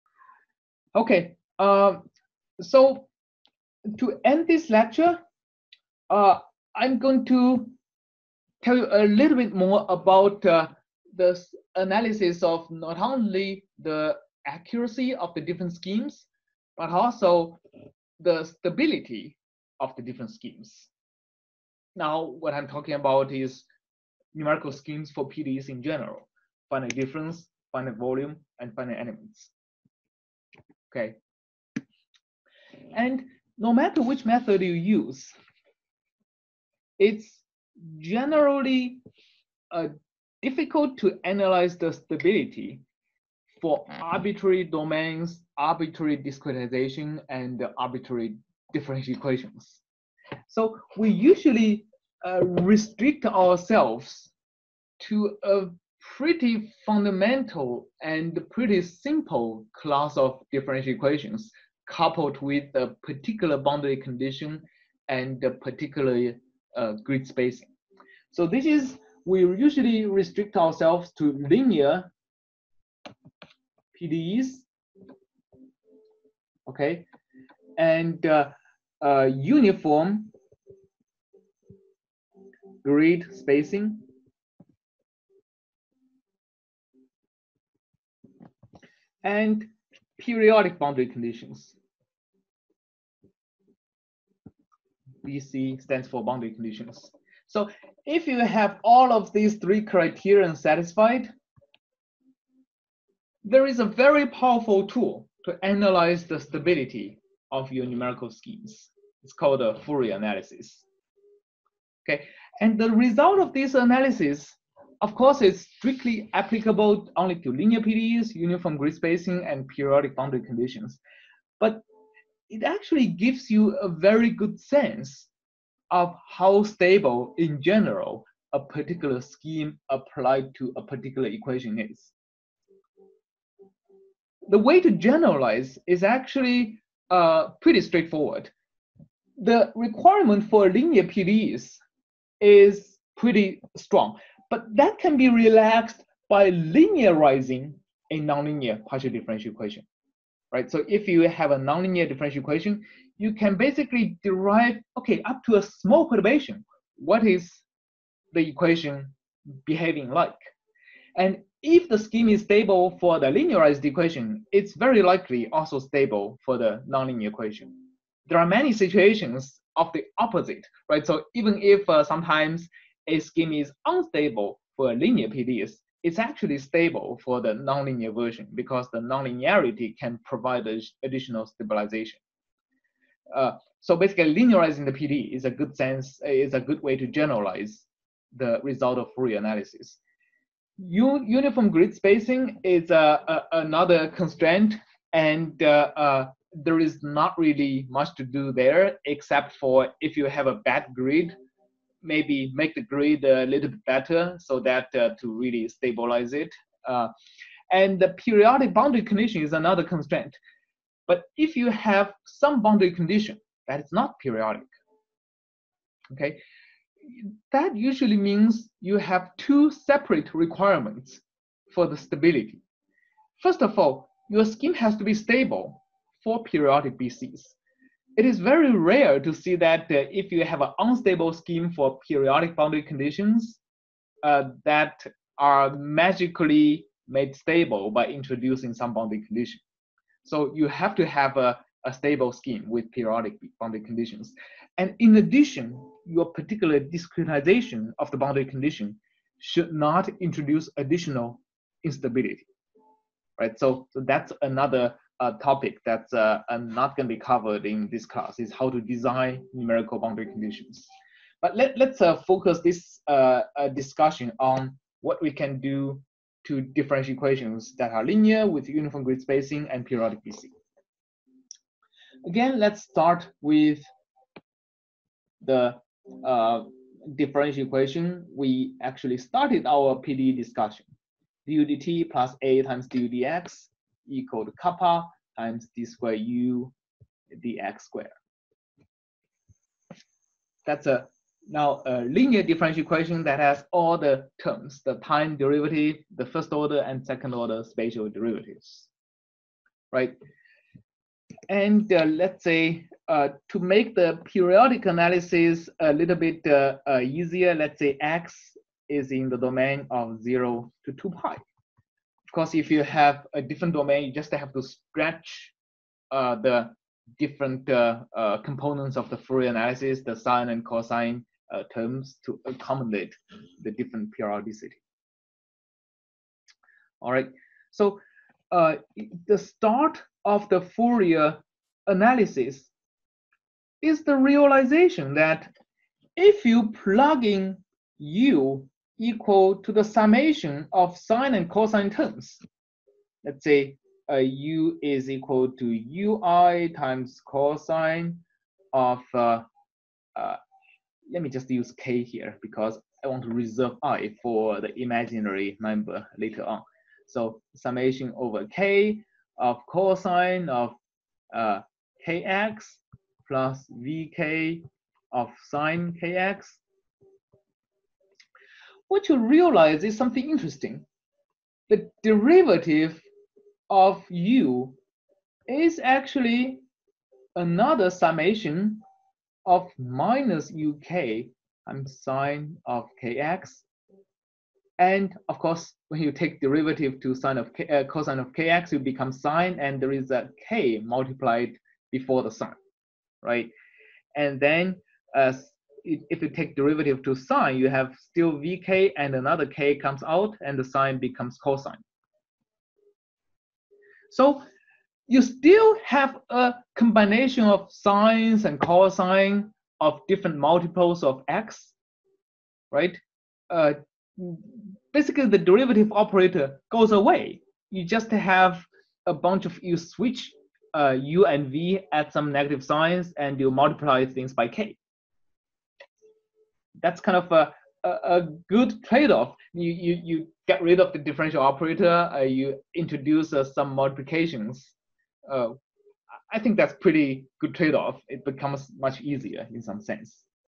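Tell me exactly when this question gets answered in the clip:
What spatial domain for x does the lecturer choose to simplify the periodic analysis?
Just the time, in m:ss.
5:10.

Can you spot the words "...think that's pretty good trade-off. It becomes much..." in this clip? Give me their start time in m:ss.
7:16.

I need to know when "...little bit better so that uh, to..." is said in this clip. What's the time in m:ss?
3:23.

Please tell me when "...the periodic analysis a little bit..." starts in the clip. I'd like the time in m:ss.
5:03.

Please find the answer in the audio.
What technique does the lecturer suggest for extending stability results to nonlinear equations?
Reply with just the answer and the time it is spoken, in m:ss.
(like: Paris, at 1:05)
Linearizing the PDE, at 2:26.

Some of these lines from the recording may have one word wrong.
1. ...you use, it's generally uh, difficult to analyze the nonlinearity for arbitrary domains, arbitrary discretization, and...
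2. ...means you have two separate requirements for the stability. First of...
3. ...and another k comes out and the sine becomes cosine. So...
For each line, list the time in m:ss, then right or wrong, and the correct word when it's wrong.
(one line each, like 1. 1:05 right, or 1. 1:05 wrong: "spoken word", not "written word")
1. 0:34 wrong: "stability", not "nonlinearity"
2. 3:38 right
3. 6:38 right.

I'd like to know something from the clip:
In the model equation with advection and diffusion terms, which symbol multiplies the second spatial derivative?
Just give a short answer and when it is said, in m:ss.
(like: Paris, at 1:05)
kappa, at 4:44.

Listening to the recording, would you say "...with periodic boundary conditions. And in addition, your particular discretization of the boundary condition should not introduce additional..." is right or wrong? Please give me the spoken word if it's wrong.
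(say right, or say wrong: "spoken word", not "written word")
right.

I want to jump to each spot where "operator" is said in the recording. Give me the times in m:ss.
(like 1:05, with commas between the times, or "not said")
6:55, 7:11.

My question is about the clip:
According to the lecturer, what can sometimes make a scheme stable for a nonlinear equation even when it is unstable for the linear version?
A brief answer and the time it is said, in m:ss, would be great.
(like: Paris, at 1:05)
The nonlinearity, at 2:58.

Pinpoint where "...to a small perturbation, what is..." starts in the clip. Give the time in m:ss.
2:35.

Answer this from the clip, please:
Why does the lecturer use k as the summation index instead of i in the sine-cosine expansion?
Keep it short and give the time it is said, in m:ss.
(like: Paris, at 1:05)
To reserve i for the imaginary number, at 5:53.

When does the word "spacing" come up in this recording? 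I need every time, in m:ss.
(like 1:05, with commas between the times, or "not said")
1:07, 1:23, 1:58, 3:11, 4:29.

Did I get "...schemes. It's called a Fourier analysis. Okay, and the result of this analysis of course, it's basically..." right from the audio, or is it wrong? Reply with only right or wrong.
wrong.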